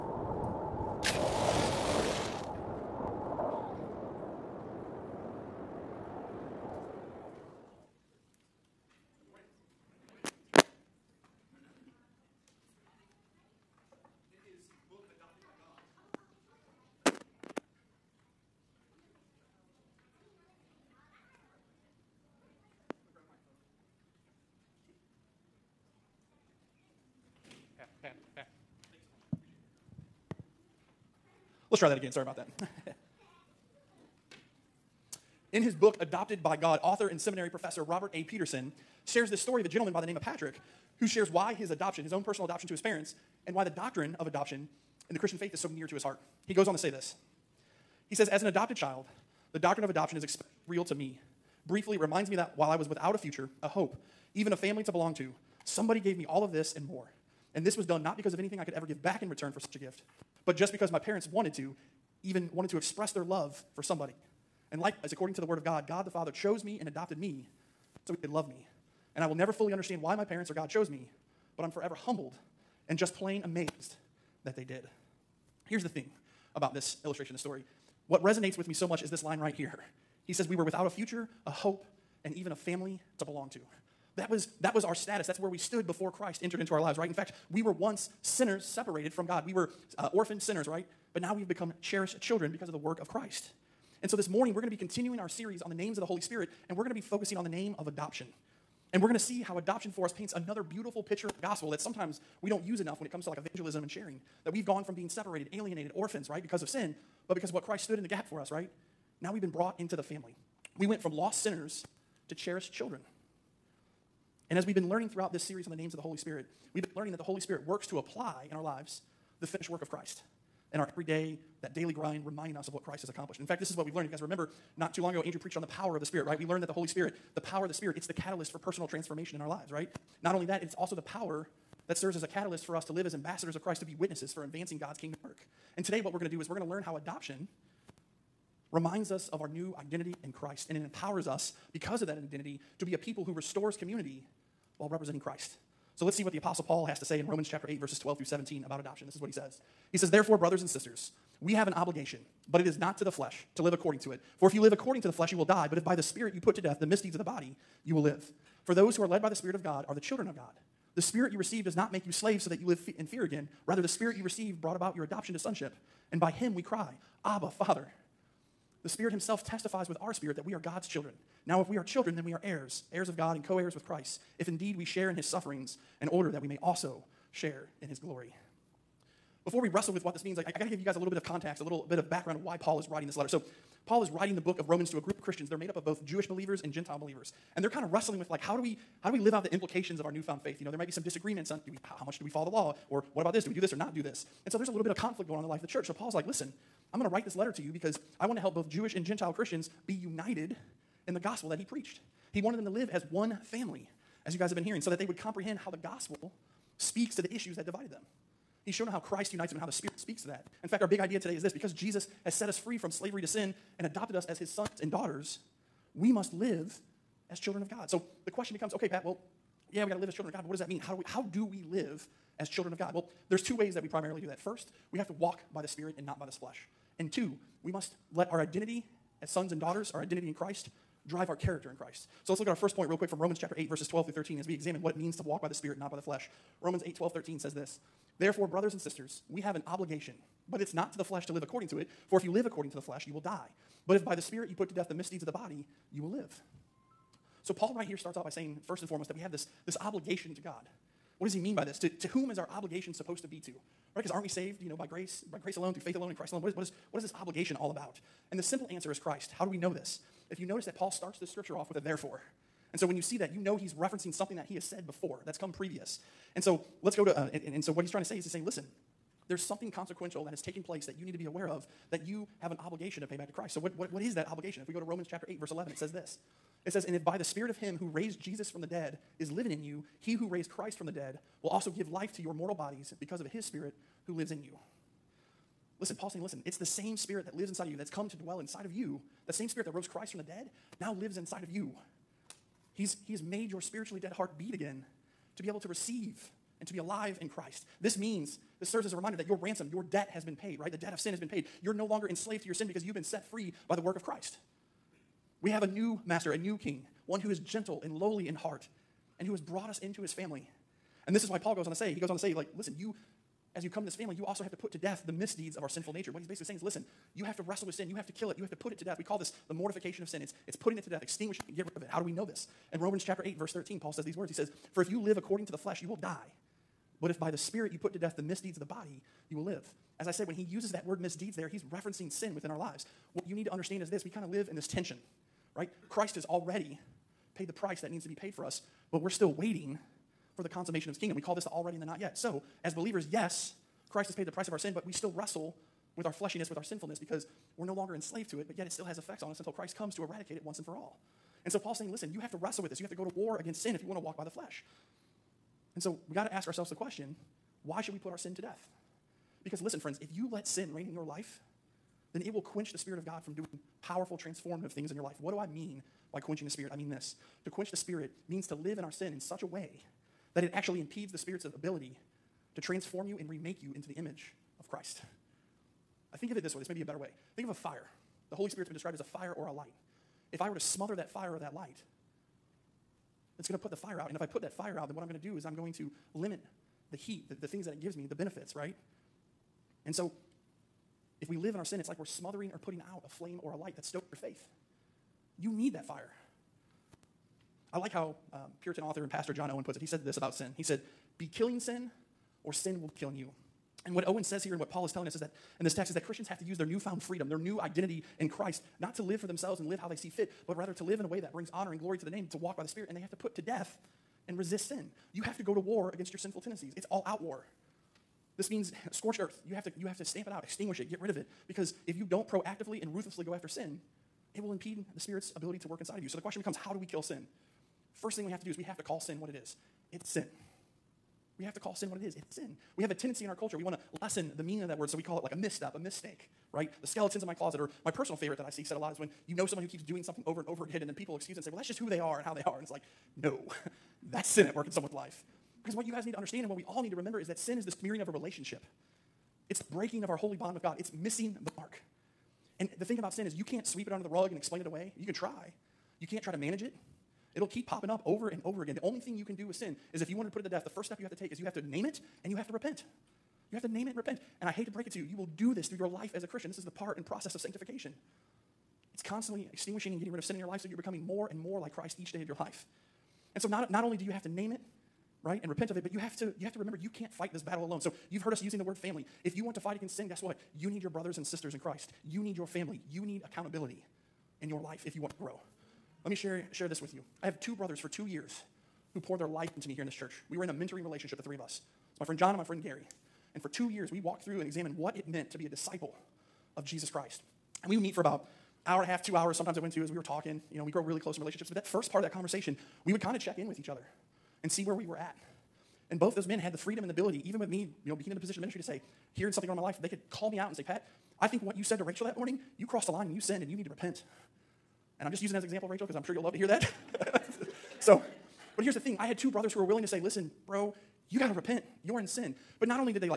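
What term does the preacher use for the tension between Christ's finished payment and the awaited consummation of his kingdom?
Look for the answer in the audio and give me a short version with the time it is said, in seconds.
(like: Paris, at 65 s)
the already and the not yet, at 341 s.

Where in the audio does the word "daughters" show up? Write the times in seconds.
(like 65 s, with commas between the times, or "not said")
214 s, 229 s.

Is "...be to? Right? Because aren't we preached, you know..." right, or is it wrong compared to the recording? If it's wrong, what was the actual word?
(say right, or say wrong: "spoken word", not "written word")
wrong: "saved", not "preached".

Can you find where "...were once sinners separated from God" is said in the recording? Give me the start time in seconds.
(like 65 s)
87 s.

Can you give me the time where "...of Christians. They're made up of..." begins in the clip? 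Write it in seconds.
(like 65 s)
185 s.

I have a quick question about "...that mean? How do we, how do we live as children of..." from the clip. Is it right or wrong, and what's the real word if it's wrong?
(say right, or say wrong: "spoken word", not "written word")
right.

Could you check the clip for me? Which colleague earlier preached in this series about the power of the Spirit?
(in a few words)
Andrew.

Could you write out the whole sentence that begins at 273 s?
So, what, what, what is that obligation?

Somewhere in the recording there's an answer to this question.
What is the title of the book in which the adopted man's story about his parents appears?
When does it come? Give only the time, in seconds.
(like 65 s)
35 s.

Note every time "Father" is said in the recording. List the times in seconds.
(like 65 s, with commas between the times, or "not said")
66 s, 167 s.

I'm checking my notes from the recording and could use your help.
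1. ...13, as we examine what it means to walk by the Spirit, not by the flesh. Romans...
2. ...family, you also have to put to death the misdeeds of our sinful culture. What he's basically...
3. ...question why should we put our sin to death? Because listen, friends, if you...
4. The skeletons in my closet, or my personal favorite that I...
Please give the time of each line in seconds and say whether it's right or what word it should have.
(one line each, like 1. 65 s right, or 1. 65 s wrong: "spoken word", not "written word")
1. 234 s right
2. 313 s wrong: "nature", not "culture"
3. 356 s right
4. 436 s right.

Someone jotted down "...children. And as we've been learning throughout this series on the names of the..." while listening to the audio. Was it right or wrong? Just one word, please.
right.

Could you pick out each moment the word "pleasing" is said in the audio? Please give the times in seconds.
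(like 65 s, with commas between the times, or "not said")
not said.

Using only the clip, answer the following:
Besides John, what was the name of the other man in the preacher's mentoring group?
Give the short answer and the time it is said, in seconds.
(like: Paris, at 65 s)
Gary, at 492 s.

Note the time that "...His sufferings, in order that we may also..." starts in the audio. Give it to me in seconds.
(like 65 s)
175 s.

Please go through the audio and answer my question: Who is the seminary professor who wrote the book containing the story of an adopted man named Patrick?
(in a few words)
Robert A. Peterson.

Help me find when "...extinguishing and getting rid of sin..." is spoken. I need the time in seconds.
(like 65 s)
469 s.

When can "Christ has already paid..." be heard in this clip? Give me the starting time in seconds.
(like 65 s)
335 s.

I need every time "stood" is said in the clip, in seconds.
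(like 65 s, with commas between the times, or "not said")
85 s, 107 s.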